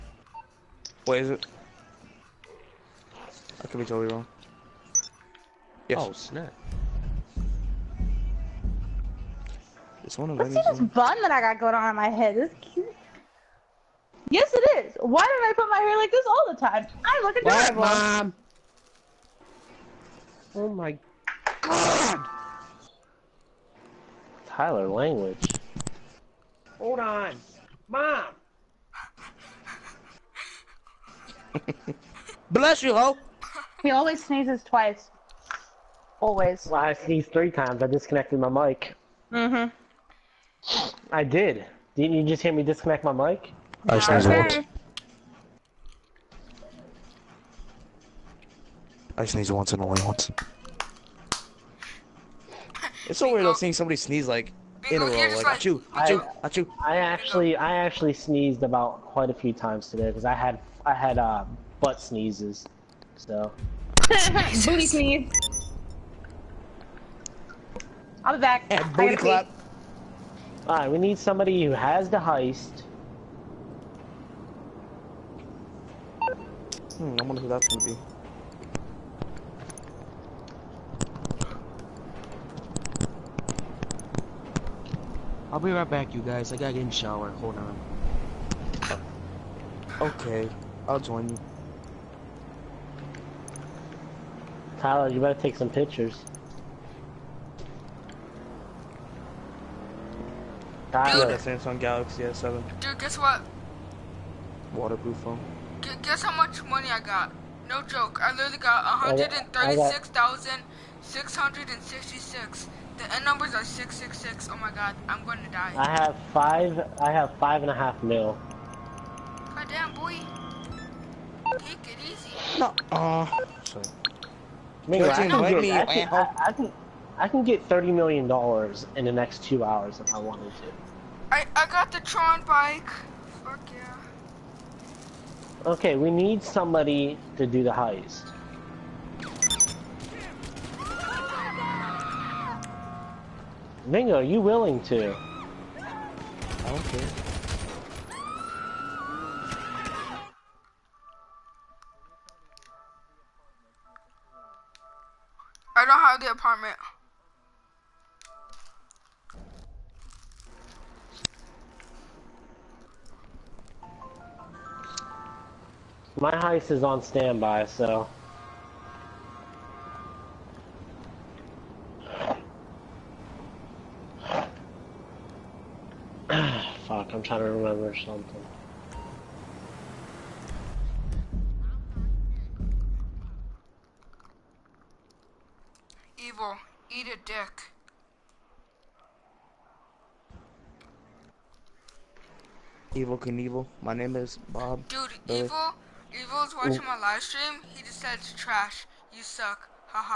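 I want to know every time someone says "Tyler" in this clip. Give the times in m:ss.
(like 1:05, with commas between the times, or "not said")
0:24, 1:34, 1:40.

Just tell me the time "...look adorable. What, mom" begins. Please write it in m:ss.
0:17.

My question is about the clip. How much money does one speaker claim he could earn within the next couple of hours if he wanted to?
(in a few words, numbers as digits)
30 million dollars.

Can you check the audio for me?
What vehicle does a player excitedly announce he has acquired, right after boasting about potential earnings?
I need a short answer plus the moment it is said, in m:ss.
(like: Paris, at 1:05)
Tron bike, at 2:12.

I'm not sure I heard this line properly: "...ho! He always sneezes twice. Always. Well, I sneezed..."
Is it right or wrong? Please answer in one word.
right.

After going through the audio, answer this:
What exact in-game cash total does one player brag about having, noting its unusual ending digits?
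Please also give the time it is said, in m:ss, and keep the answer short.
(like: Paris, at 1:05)
136,666, at 1:49.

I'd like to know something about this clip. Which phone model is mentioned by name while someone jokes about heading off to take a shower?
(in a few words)
Samsung Galaxy S7.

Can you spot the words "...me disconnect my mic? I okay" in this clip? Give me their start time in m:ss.
0:42.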